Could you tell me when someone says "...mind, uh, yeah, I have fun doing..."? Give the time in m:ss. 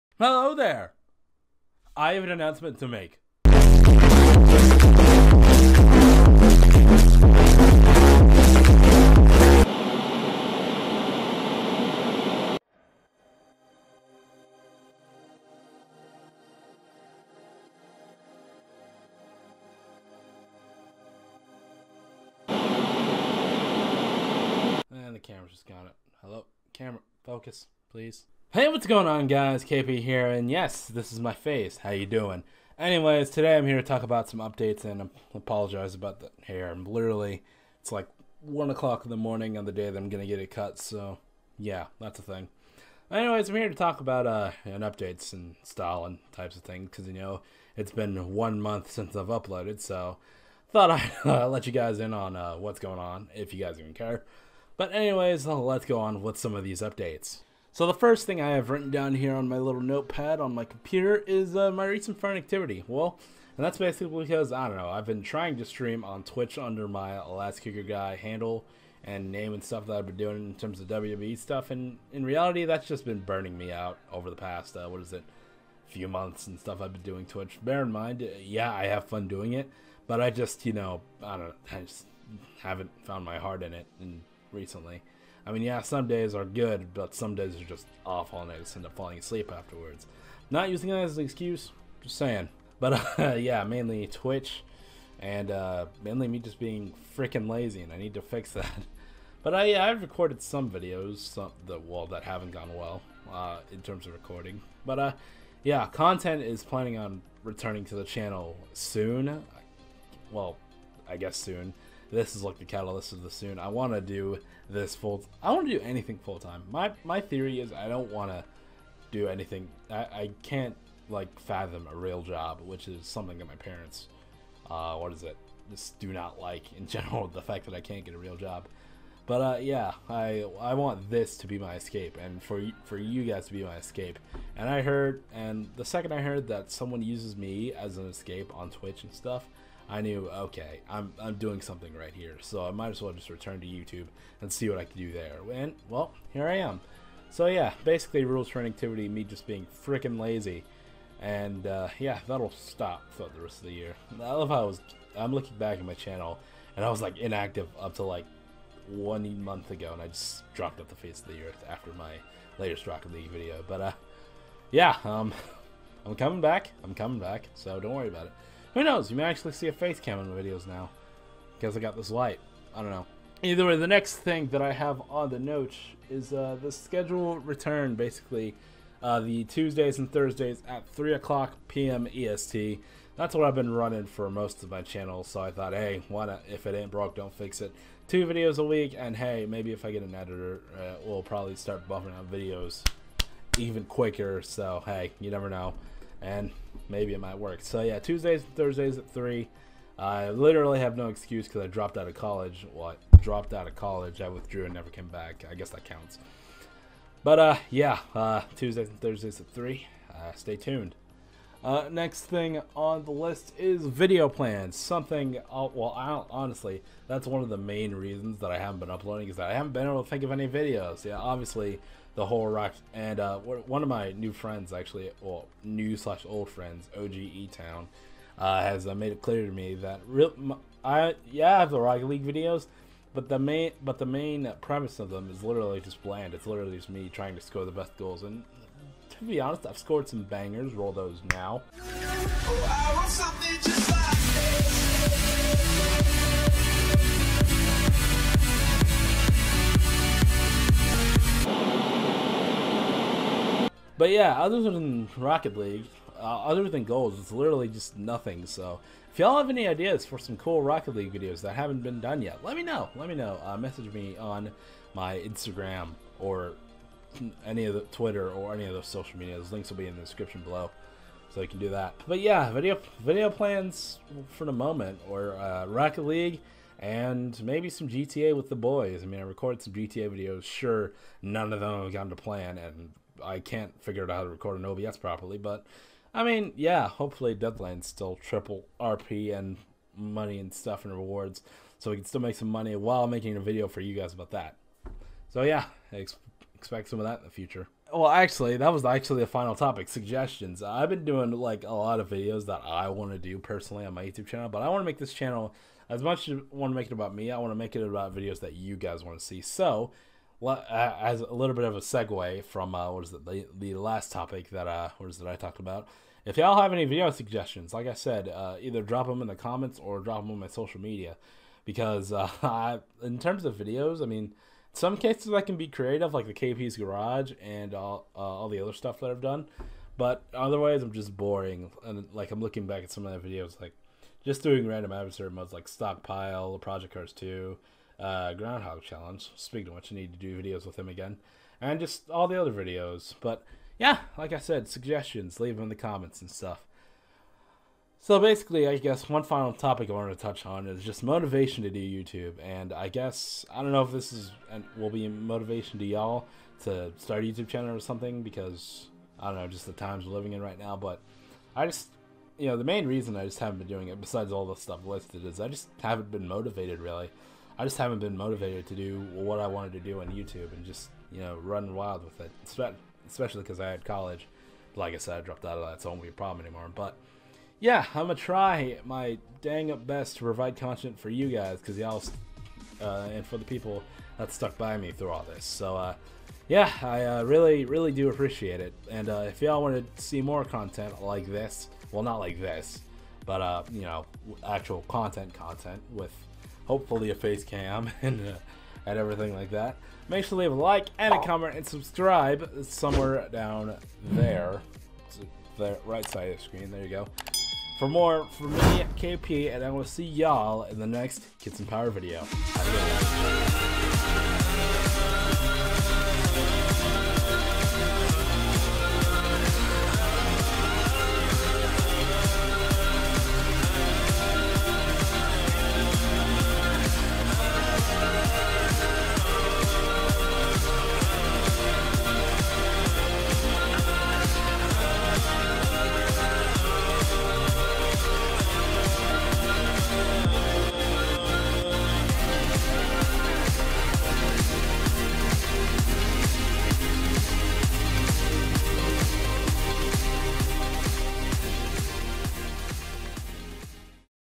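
1:17.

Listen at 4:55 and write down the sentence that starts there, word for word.
So yeah, ex expect some of that in the future.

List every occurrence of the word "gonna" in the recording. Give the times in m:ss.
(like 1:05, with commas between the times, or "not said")
6:18.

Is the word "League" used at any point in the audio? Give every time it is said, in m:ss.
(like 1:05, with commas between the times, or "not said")
3:52, 4:15, 4:20, 4:36.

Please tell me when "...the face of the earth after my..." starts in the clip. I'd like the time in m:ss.
2:40.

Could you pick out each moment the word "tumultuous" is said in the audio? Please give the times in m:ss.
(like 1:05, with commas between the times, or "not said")
not said.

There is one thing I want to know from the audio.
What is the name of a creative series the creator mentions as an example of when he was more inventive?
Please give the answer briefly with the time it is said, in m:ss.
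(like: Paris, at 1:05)
KP's Garage, at 5:26.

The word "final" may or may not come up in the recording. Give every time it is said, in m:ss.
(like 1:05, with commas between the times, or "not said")
4:59, 5:49.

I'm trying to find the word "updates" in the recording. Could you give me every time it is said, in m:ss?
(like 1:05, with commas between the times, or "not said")
0:34, 0:44, 0:56.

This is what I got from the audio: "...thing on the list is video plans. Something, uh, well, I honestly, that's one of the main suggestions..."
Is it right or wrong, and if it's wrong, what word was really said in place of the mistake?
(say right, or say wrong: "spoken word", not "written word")
wrong: "reasons", not "suggestions".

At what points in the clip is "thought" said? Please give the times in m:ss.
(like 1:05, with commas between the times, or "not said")
0:50, 3:05.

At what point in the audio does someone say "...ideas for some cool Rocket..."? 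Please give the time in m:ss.
4:19.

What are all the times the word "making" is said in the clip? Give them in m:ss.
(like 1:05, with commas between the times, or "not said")
4:53.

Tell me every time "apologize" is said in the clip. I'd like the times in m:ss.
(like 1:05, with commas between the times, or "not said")
0:35.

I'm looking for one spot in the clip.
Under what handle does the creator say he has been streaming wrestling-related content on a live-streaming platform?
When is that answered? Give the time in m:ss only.
1:07.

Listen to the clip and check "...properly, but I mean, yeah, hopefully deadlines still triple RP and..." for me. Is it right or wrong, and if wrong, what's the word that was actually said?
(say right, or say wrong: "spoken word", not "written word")
right.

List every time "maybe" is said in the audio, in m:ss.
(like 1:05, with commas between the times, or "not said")
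3:09, 3:16, 4:37.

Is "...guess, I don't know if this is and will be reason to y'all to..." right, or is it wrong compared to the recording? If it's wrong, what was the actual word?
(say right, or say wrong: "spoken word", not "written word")
wrong: "motivation", not "reason".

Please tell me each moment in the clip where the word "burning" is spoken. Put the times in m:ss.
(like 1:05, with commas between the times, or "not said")
1:13.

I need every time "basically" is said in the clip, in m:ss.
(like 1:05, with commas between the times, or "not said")
1:03, 2:27, 2:57, 5:48.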